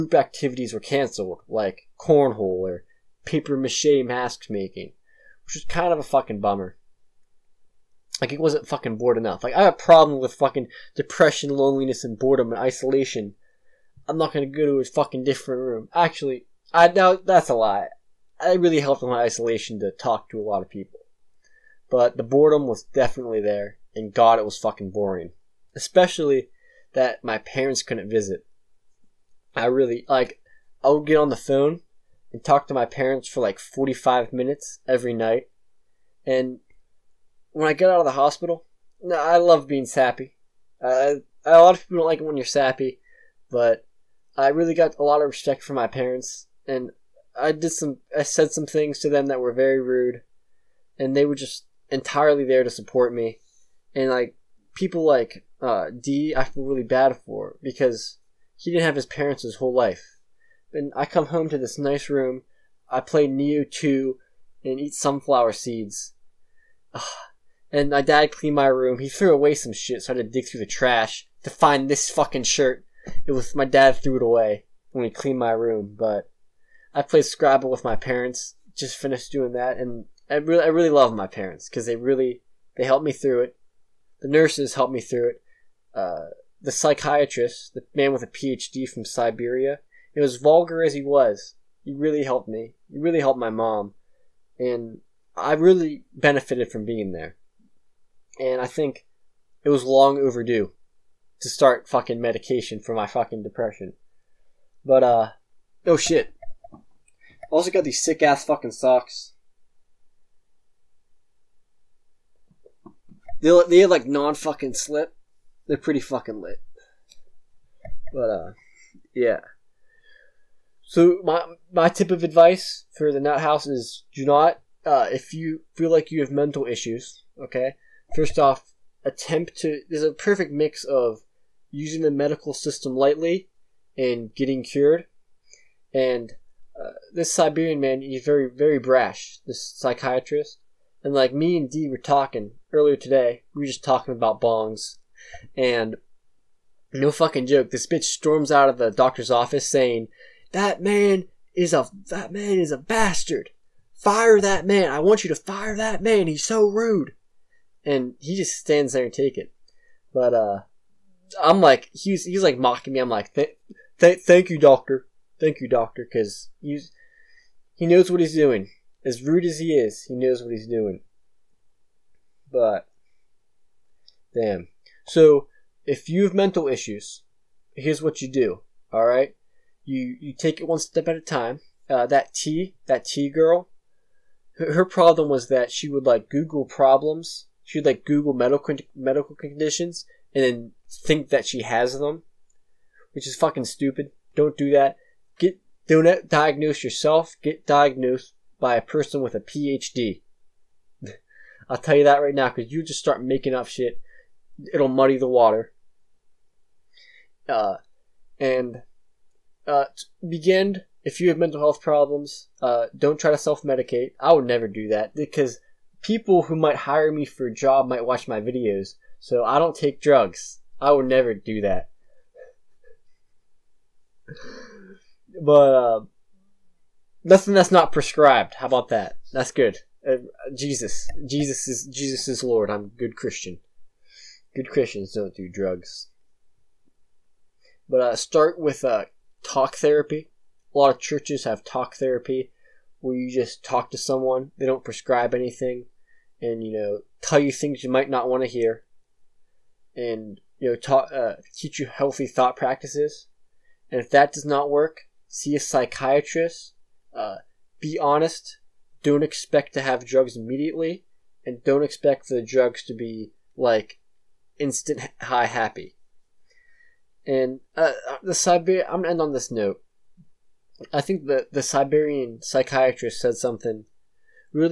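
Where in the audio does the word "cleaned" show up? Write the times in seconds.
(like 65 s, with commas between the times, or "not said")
68 s, 75 s.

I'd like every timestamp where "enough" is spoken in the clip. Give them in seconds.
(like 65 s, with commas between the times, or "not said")
9 s.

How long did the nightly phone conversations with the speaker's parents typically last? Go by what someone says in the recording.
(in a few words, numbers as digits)
45 minutes.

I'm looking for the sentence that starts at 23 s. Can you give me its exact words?
And God, it was fucking boring, especially that my parents couldn't visit.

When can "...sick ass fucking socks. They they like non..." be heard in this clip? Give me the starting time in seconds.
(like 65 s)
108 s.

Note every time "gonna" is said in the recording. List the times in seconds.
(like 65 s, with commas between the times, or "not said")
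14 s, 269 s.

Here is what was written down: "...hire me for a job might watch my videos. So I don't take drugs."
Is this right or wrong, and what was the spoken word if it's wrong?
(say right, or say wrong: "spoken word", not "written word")
right.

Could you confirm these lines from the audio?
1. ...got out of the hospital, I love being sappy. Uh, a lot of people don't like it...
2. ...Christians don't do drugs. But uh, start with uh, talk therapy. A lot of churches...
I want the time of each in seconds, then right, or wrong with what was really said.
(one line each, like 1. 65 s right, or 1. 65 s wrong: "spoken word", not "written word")
1. 37 s right
2. 234 s right.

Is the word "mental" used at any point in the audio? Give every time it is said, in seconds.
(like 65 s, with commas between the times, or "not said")
126 s, 176 s, 211 s.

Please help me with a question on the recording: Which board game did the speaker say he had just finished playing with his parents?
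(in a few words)
Scrabble.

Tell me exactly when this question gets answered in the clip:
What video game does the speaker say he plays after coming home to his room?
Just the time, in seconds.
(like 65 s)
63 s.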